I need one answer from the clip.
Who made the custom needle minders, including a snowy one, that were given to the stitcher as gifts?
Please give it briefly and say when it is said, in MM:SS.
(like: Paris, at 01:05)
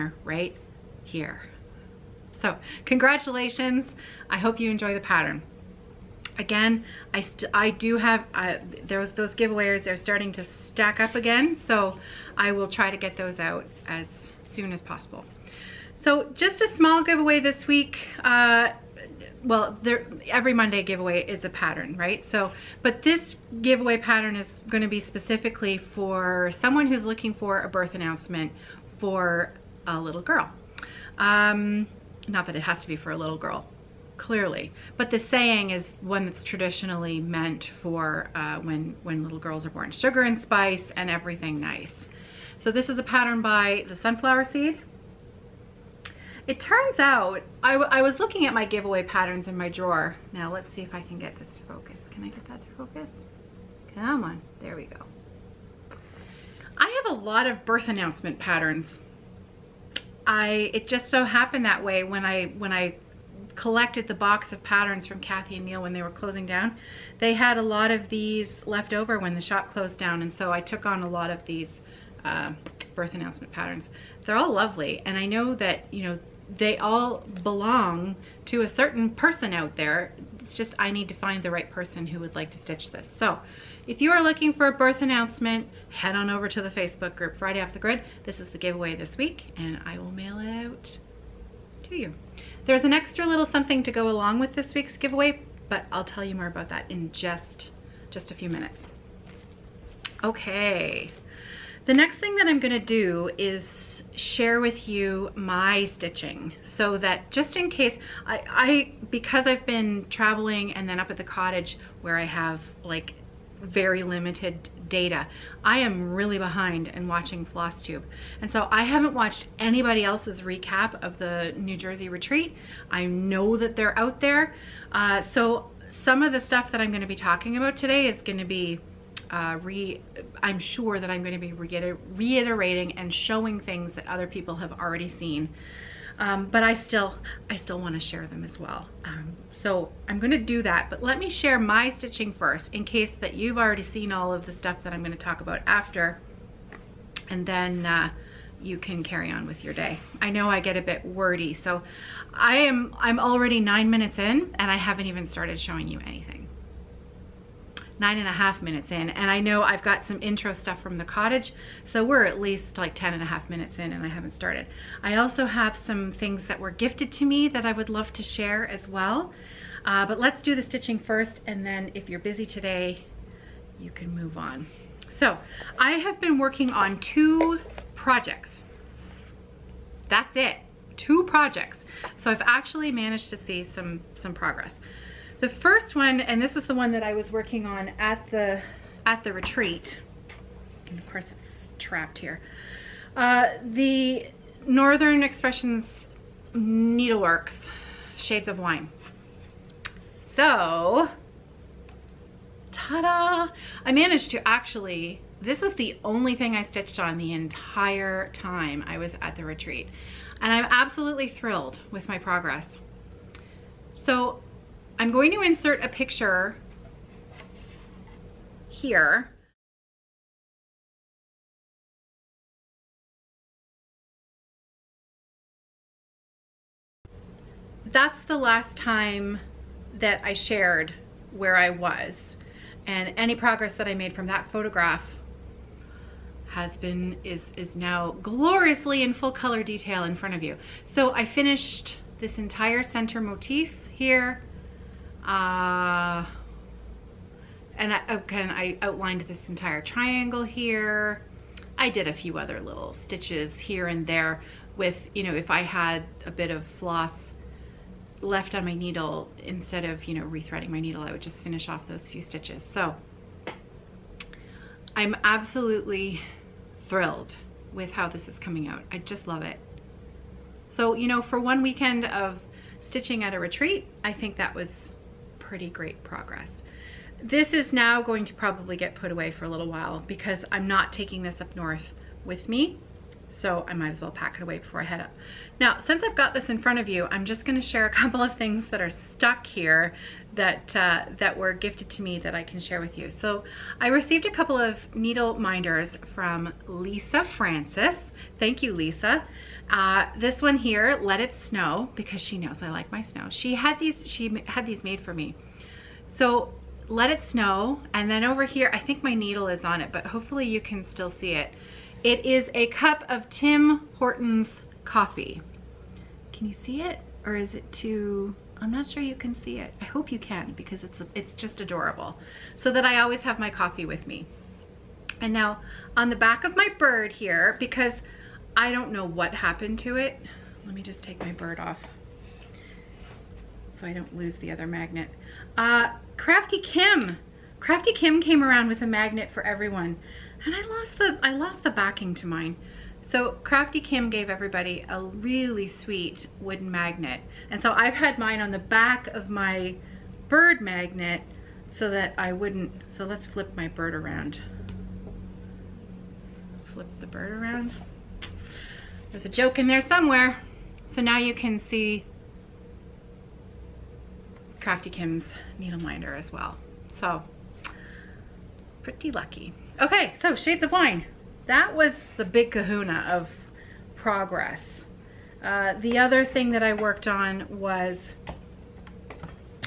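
Lisa Francis, at 04:56.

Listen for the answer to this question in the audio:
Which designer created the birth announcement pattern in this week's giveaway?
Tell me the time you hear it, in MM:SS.
00:43.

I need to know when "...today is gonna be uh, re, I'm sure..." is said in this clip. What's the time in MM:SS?
02:07.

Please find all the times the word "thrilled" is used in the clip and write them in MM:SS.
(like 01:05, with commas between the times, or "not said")
03:31, 04:26.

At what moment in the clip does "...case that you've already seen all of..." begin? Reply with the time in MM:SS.
02:22.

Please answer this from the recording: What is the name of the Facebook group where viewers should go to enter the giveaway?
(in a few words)
Friday Off the Grid.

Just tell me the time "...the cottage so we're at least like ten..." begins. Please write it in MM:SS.
02:40.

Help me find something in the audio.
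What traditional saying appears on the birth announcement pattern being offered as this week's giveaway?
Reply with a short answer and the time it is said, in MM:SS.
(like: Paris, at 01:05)
Sugar and spice and everything nice, at 00:39.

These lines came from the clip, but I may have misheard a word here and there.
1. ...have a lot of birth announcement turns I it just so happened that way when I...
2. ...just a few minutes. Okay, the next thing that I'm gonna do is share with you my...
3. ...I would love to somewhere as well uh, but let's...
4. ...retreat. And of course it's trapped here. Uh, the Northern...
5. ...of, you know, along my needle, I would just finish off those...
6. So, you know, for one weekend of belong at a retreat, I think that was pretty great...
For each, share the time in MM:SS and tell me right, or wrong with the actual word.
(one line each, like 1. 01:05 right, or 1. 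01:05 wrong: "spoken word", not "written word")
1. 00:57 wrong: "patterns", not "turns"
2. 01:38 right
3. 02:47 wrong: "share", not "somewhere"
4. 03:09 right
5. 04:19 wrong: "rethreading", not "along"
6. 04:30 wrong: "stitching", not "belong".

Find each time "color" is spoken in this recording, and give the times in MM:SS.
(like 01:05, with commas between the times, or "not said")
03:59.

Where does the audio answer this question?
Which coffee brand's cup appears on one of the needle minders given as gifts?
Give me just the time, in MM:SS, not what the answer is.
05:13.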